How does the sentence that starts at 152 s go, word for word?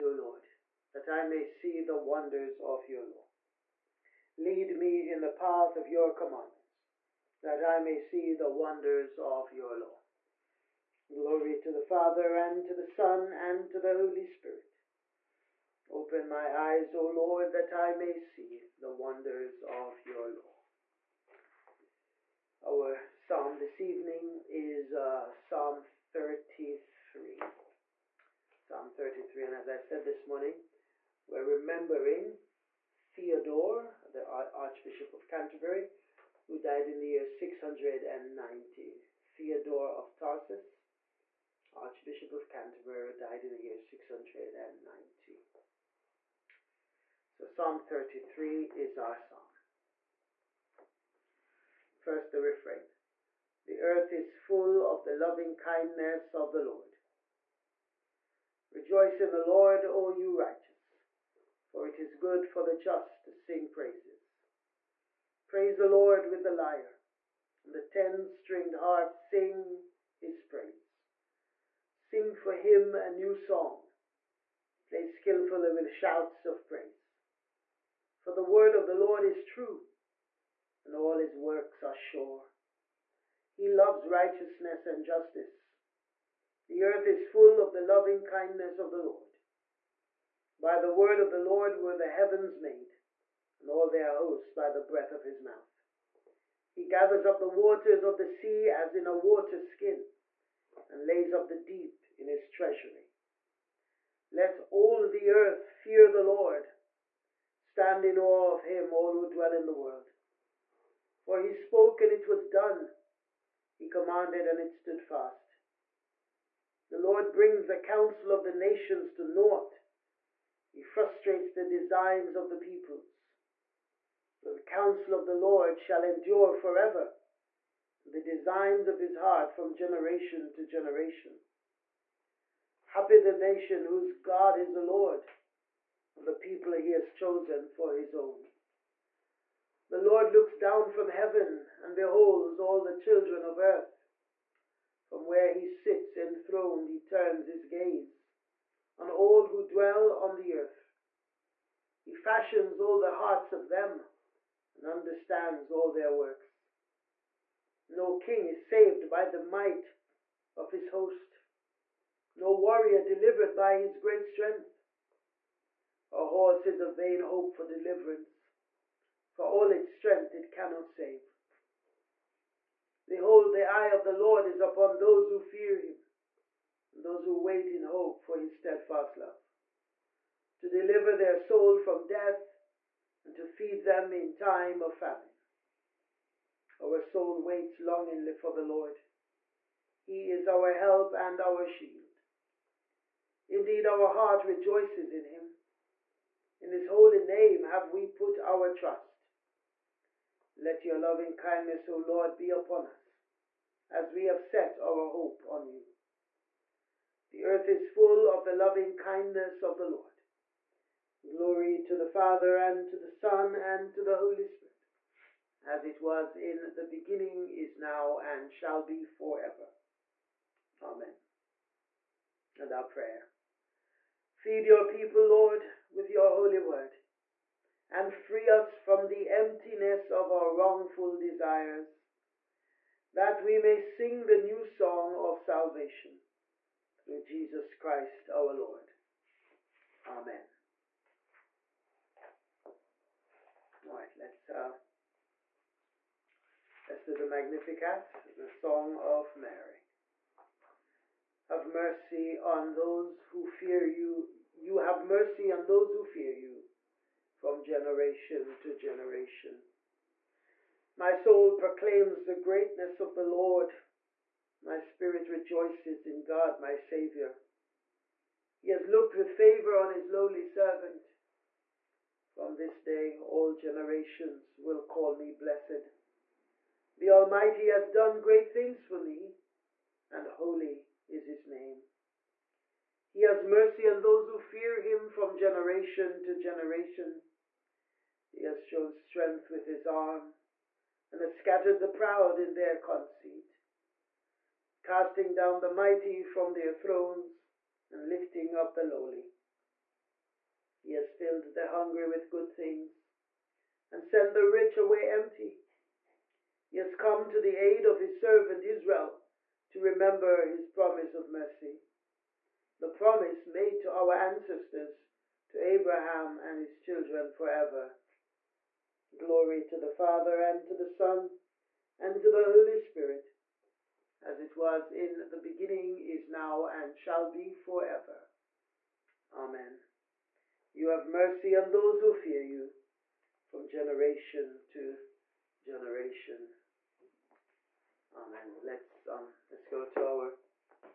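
He fashions all the hearts of them and understands all their works.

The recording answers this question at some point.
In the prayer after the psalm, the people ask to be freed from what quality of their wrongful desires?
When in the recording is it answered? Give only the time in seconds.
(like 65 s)
229 s.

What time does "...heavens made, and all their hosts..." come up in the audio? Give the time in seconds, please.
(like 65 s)
92 s.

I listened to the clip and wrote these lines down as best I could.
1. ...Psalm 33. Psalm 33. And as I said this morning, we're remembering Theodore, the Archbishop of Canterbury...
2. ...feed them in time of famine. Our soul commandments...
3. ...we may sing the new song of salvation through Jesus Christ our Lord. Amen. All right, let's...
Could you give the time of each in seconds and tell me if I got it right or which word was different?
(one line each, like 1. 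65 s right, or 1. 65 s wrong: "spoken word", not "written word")
1. 25 s right
2. 183 s wrong: "waits", not "commandments"
3. 233 s right.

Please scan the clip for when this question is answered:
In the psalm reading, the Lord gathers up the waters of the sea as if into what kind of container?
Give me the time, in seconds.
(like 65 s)
99 s.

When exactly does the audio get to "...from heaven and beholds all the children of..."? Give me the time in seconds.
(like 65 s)
140 s.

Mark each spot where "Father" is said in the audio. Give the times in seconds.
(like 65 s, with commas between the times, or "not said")
11 s, 212 s, 319 s.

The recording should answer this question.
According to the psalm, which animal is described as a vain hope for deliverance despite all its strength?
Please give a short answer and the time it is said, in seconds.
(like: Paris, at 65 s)
A horse, at 166 s.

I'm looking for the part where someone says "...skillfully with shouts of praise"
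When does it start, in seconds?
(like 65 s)
75 s.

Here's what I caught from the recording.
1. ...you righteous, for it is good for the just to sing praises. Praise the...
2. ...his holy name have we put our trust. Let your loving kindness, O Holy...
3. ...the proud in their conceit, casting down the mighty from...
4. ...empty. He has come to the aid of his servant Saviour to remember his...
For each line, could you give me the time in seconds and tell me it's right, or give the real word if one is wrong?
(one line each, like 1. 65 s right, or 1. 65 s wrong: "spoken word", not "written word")
1. 60 s right
2. 196 s wrong: "Lord", not "Holy"
3. 291 s right
4. 305 s wrong: "Israel", not "Saviour".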